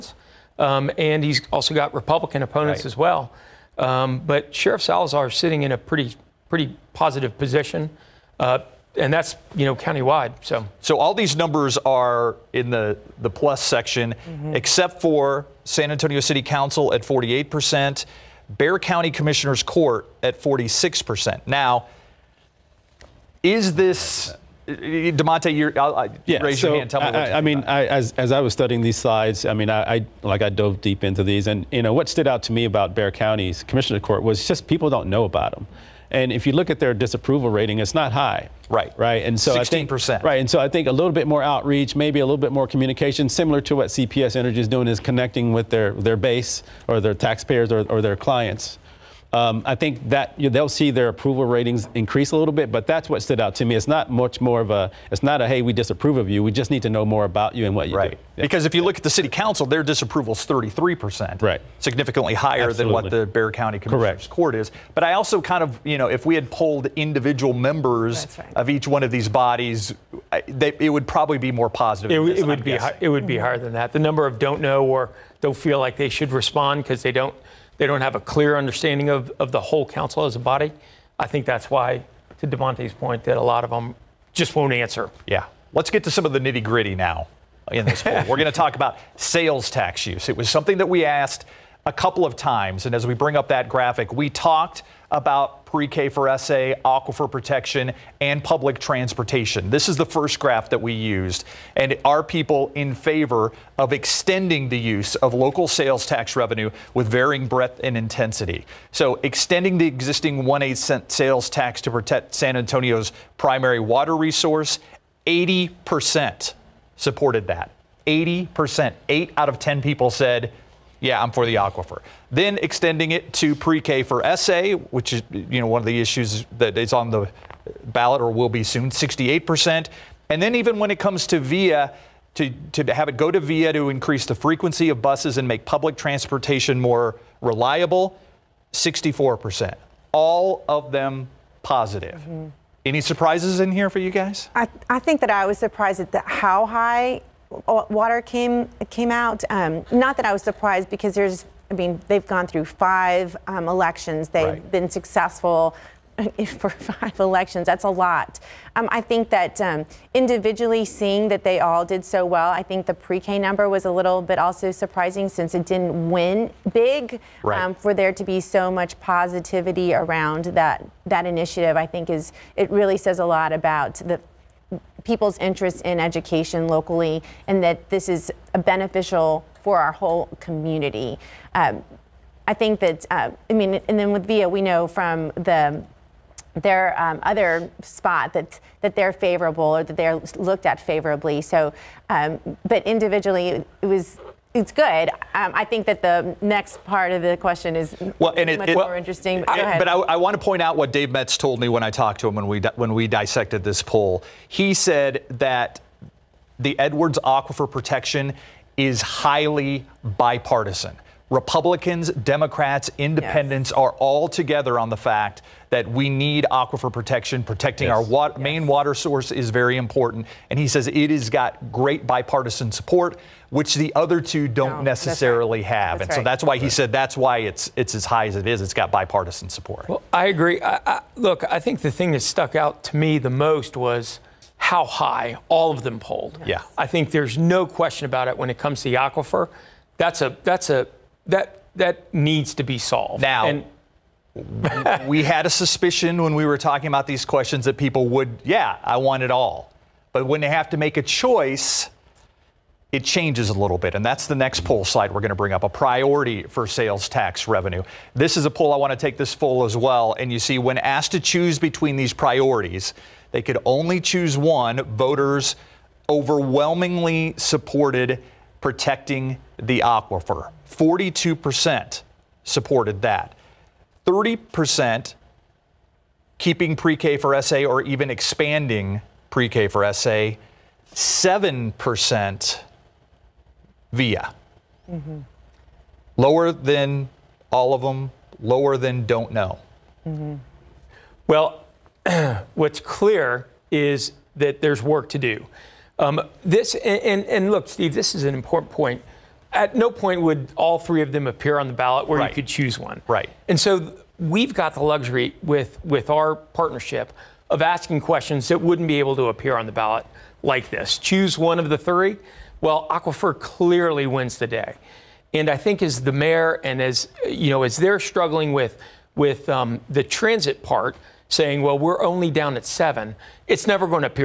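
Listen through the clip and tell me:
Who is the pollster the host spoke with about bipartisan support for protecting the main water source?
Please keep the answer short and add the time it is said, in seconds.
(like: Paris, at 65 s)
Dave Metz, at 200 s.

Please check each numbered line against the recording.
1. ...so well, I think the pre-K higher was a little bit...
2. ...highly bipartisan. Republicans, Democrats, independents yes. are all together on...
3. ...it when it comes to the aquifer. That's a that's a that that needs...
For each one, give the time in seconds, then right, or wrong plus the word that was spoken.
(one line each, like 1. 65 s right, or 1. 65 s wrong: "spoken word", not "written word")
1. 162 s wrong: "number", not "higher"
2. 209 s right
3. 238 s right.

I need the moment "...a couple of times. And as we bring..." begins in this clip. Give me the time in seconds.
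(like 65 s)
91 s.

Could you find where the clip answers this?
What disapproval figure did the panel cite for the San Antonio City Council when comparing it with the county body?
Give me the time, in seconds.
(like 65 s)
60 s.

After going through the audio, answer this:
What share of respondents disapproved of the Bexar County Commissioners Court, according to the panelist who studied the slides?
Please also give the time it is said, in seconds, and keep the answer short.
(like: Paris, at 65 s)
16%, at 39 s.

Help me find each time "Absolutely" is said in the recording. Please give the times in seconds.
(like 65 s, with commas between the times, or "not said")
62 s.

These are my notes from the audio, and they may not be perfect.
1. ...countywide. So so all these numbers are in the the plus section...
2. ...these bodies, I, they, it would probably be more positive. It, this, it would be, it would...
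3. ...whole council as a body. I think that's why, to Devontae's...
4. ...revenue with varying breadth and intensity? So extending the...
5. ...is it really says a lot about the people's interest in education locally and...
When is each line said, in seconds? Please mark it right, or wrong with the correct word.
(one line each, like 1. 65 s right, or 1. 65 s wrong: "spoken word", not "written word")
1. 9 s right
2. 69 s right
3. 79 s right
4. 106 s right
5. 172 s right.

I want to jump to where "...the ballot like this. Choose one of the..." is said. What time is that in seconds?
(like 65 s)
309 s.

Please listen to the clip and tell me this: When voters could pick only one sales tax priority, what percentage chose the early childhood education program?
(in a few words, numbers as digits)
30%.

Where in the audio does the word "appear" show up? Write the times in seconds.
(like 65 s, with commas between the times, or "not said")
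301 s, 309 s.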